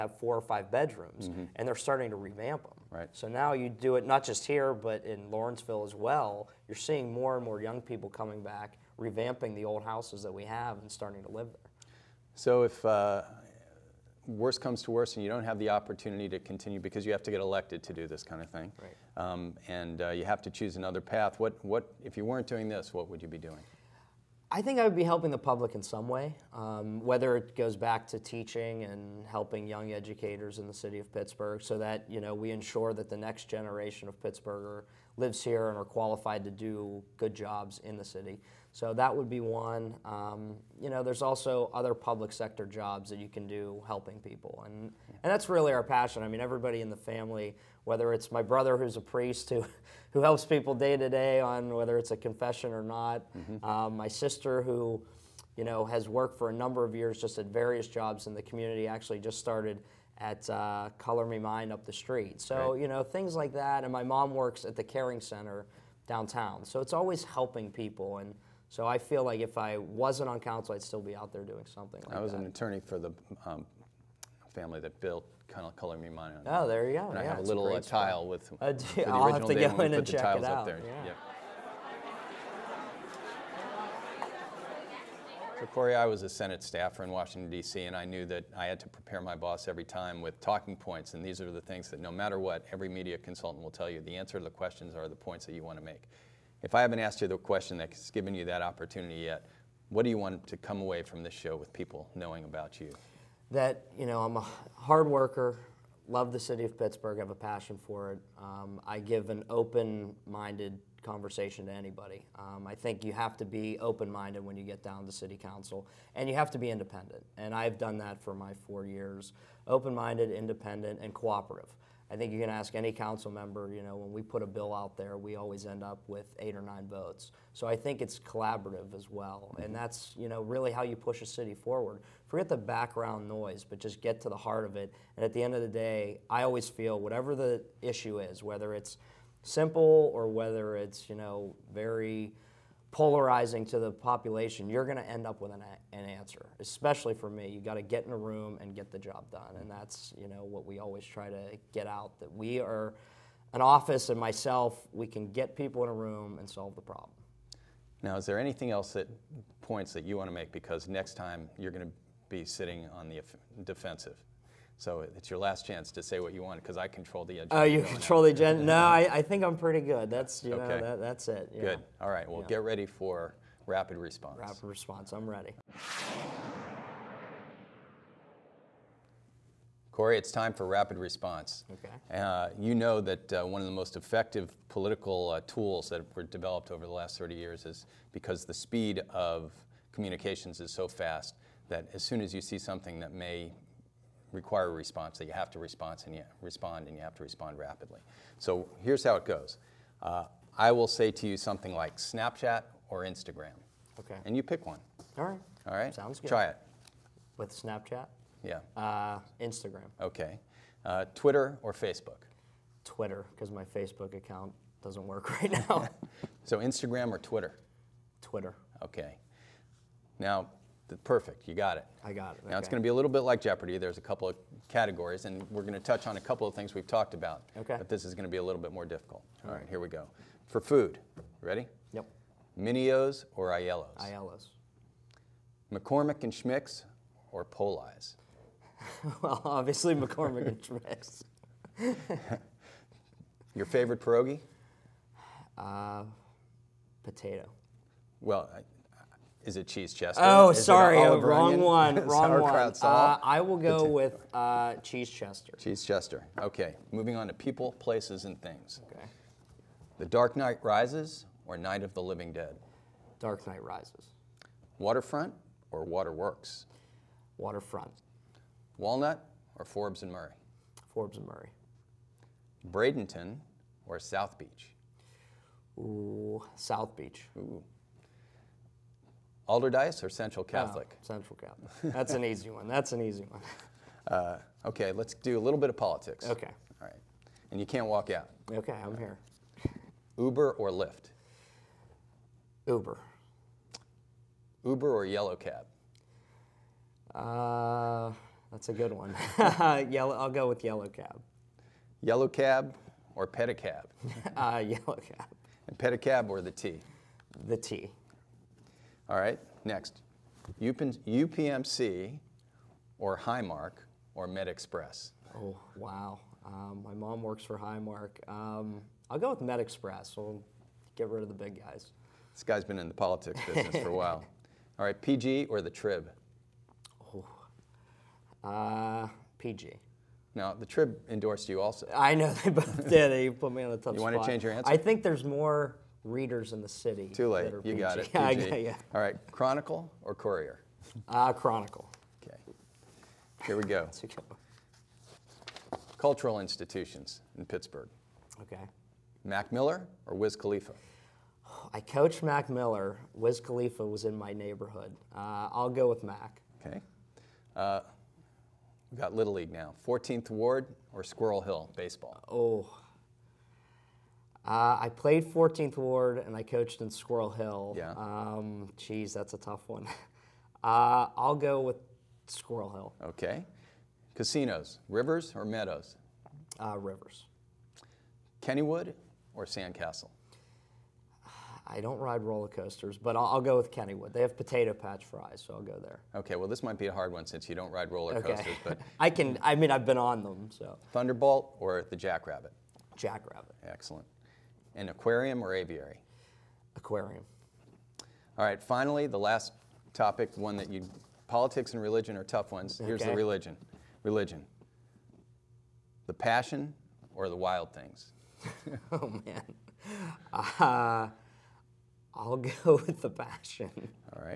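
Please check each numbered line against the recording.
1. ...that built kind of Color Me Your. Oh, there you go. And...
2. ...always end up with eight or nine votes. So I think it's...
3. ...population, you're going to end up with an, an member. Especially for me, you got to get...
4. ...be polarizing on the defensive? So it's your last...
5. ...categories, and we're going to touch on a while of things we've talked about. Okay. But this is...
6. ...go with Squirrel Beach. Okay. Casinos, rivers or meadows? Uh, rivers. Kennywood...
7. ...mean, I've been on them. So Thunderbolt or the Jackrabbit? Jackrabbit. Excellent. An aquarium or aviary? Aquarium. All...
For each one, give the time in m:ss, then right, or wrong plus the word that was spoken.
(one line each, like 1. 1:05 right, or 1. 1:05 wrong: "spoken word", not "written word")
1. 1:14 wrong: "Mine", not "Your"
2. 2:05 right
3. 2:23 wrong: "answer", not "member"
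4. 2:42 wrong: "sitting", not "polarizing"
5. 3:44 wrong: "couple", not "while"
6. 6:11 wrong: "Hill", not "Beach"
7. 6:29 right.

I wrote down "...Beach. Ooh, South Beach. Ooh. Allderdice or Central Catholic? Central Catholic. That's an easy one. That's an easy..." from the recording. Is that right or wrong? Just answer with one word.
right.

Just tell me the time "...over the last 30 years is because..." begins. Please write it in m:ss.
3:06.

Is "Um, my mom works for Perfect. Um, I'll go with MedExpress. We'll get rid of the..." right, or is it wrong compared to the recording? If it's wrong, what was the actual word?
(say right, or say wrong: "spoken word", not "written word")
wrong: "Highmark", not "Perfect".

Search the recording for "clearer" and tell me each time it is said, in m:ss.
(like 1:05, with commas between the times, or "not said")
not said.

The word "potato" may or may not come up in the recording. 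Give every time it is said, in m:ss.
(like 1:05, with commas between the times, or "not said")
4:07, 6:24.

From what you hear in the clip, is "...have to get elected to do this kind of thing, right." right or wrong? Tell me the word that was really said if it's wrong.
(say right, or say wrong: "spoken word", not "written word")
right.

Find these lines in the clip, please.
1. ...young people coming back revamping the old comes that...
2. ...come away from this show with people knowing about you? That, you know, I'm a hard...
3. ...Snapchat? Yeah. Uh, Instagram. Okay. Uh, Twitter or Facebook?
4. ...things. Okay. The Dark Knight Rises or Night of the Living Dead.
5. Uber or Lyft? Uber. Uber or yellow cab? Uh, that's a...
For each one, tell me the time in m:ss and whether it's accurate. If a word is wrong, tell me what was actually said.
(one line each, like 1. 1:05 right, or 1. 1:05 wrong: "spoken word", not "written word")
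1. 0:07 wrong: "houses", not "comes"
2. 1:40 right
3. 3:27 right
4. 4:18 right
5. 4:50 right.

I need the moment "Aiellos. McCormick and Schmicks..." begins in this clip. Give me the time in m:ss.
3:54.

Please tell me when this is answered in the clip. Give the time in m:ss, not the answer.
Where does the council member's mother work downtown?
1:04.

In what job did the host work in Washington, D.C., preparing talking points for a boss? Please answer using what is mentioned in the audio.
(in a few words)
Senate staffer.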